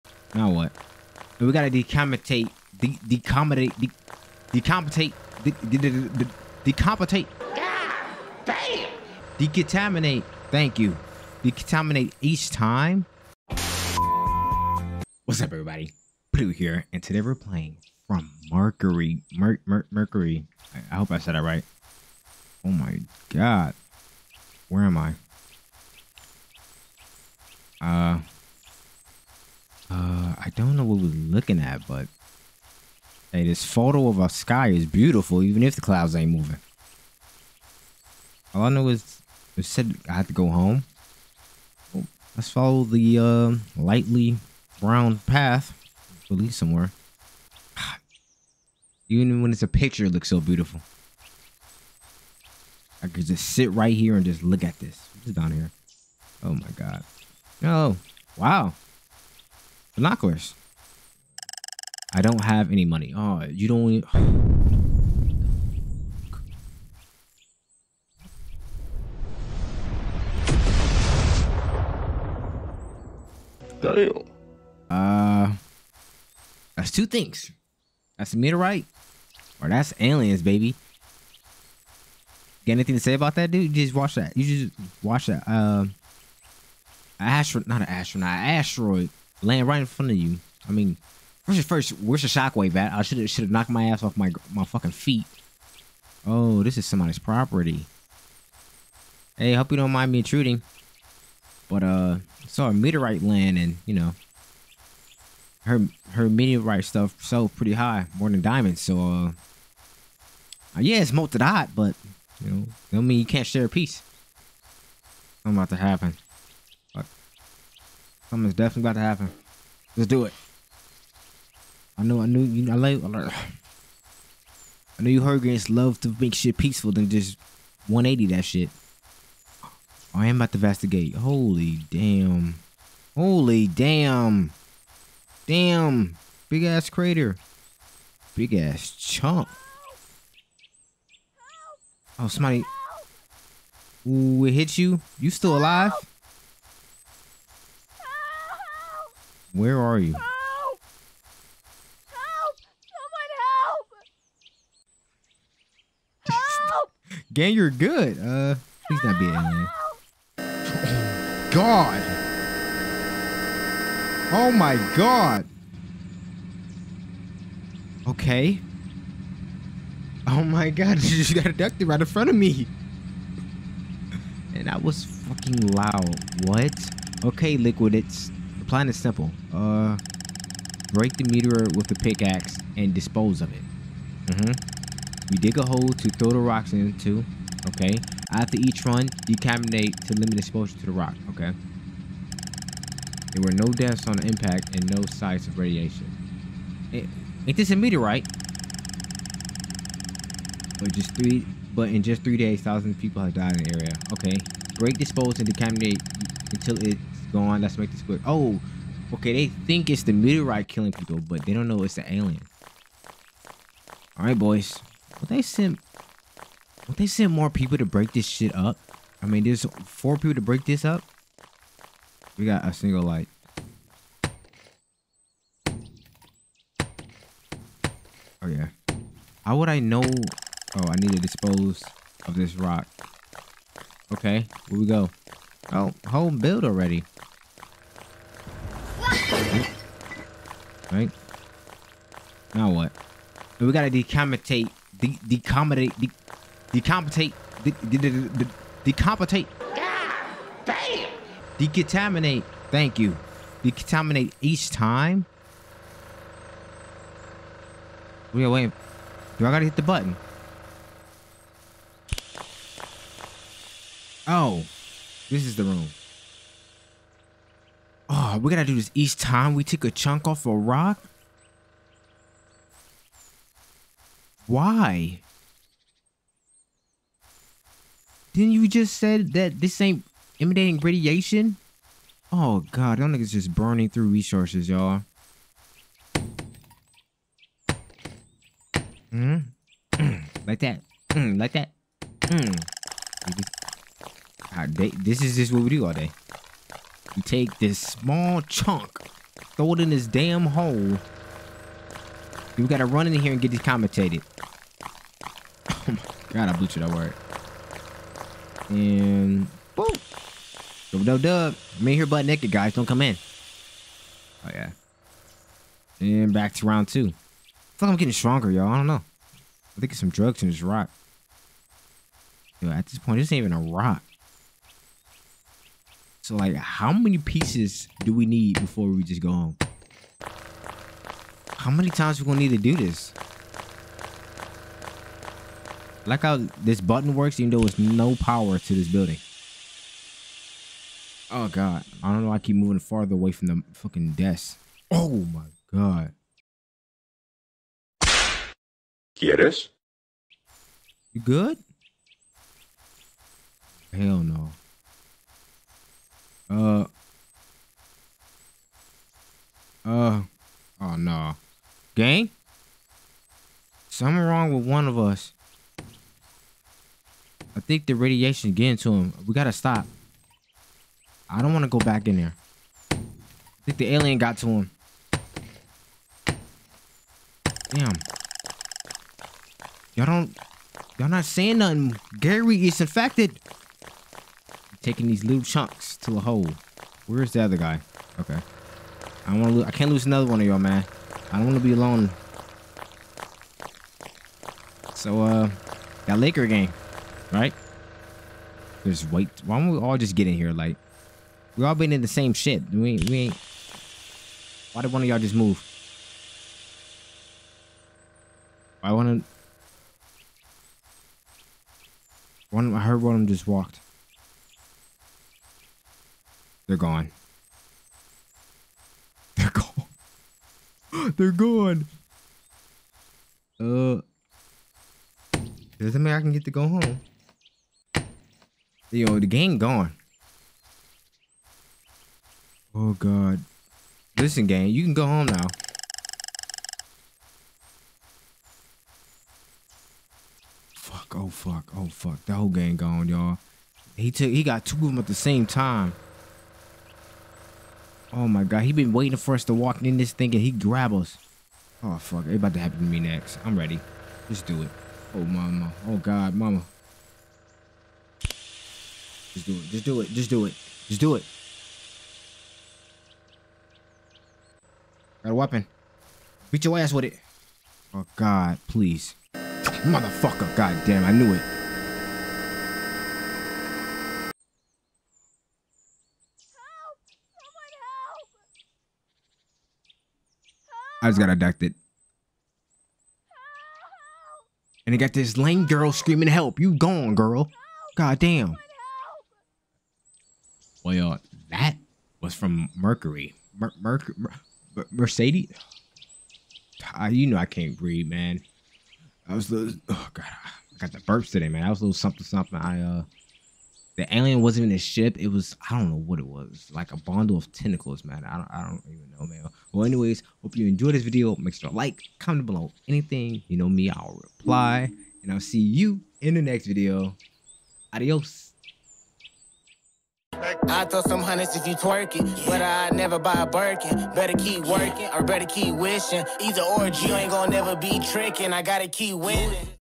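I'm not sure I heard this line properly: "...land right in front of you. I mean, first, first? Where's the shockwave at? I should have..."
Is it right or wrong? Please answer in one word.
right.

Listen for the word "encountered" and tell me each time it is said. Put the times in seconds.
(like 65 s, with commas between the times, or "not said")
not said.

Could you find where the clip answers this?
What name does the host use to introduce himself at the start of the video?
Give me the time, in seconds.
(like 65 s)
16 s.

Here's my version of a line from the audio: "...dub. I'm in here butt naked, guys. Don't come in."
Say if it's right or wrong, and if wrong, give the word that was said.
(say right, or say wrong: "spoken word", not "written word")
right.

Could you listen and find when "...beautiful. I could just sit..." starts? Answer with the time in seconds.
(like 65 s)
50 s.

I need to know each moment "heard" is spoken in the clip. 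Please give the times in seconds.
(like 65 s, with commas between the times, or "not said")
125 s, 412 s.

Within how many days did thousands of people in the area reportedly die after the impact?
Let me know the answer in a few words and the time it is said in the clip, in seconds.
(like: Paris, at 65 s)
3, at 202 s.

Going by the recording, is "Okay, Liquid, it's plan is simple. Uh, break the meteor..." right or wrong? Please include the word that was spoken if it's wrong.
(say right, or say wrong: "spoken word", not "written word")
right.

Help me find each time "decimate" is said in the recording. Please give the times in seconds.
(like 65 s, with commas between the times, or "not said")
189 s, 205 s.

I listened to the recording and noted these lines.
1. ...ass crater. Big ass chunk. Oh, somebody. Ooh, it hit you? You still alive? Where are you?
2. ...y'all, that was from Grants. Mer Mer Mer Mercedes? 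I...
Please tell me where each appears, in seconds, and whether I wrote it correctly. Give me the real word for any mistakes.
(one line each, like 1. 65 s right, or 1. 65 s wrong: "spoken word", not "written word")
1. 136 s right
2. 490 s wrong: "Mercury", not "Grants".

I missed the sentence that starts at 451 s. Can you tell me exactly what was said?
Oh fuck, it about to happen to me next.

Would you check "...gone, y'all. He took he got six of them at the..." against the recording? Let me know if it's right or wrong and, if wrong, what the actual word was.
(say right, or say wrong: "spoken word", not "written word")
wrong: "two", not "six".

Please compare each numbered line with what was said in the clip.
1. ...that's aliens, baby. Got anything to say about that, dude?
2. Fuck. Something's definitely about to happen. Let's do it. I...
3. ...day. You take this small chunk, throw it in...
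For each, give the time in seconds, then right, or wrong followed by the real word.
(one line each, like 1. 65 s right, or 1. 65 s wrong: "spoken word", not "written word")
1. 79 s right
2. 116 s right
3. 295 s right.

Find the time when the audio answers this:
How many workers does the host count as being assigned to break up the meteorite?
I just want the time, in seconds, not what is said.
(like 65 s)
219 s.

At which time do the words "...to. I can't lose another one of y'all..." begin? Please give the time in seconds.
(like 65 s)
389 s.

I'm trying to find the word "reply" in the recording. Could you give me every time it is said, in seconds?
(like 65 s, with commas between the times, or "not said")
514 s.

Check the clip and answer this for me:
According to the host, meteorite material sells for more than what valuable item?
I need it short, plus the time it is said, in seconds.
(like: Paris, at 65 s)
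Diamonds, at 108 s.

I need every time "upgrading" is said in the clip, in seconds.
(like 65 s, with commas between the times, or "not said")
not said.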